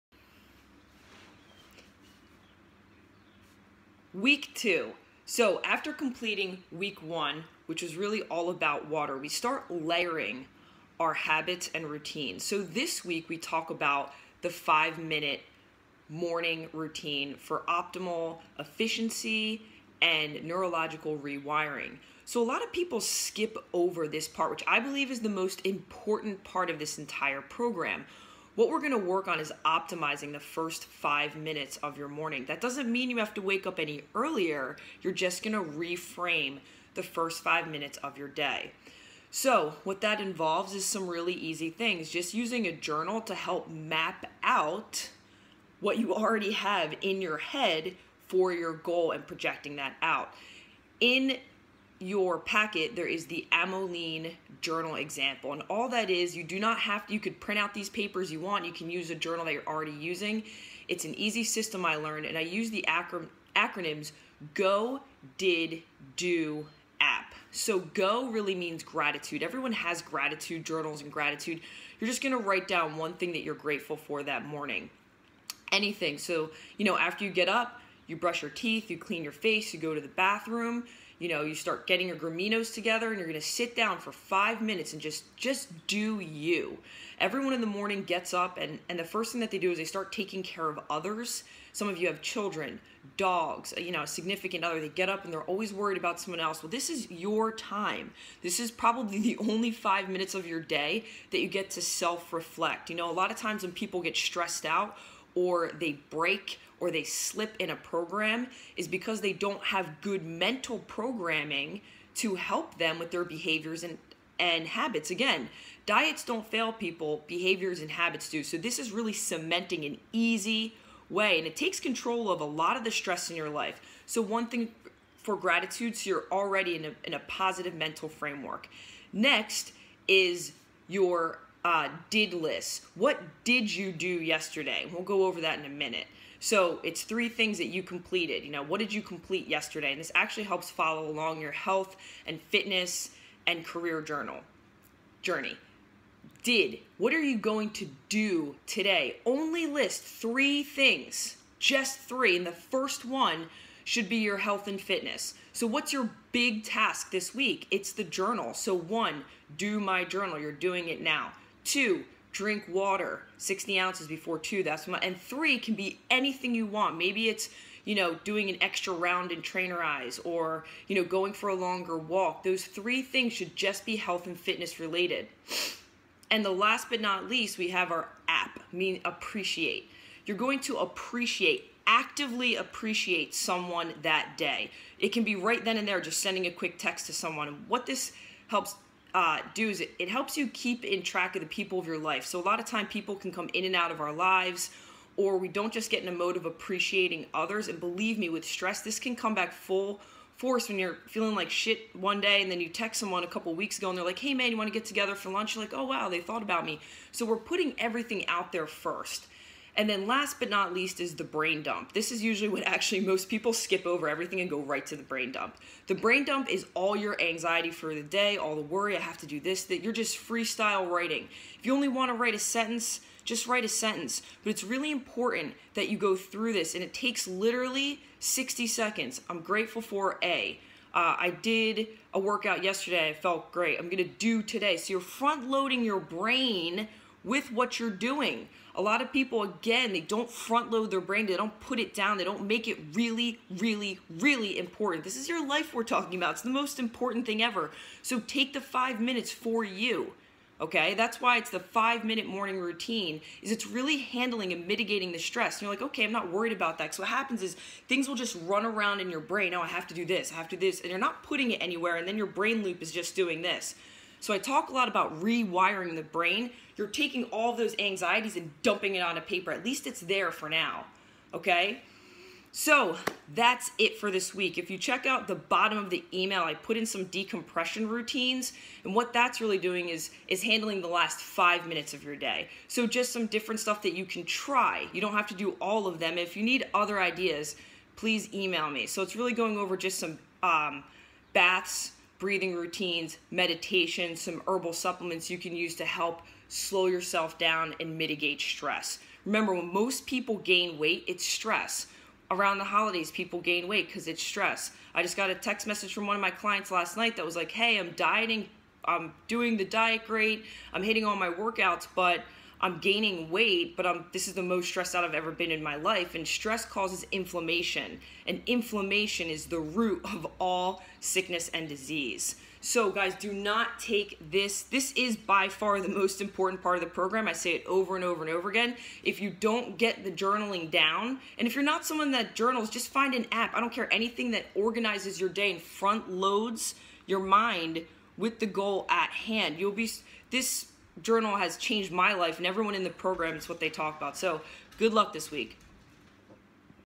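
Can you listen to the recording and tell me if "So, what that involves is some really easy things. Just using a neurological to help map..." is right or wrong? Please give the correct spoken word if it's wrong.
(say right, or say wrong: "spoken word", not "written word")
wrong: "journal", not "neurological".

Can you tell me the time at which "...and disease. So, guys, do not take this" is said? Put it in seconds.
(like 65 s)
321 s.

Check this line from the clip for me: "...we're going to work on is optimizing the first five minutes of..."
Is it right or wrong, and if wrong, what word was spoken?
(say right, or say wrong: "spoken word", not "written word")
right.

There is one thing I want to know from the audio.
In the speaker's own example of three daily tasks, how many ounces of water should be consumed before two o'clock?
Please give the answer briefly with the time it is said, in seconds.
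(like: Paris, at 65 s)
60, at 163 s.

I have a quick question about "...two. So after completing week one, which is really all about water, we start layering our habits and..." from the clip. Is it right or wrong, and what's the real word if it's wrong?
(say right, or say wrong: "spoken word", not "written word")
right.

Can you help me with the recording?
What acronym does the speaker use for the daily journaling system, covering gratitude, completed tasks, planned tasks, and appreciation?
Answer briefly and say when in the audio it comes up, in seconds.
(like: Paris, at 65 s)
GO, DID, DO, app, at 64 s.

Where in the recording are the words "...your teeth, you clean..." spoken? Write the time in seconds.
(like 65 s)
78 s.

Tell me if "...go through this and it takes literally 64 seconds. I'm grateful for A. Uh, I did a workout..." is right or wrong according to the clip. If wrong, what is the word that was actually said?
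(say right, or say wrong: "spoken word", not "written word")
wrong: "60", not "64".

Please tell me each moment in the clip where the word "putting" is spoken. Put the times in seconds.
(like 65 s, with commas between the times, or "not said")
207 s, 261 s.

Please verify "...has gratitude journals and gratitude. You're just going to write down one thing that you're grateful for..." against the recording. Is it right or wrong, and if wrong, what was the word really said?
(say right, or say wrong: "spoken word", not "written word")
right.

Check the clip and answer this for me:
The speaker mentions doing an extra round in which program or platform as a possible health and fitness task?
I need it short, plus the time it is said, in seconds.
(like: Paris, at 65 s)
Trainerize, at 169 s.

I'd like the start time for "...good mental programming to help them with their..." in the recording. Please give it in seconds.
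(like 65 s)
110 s.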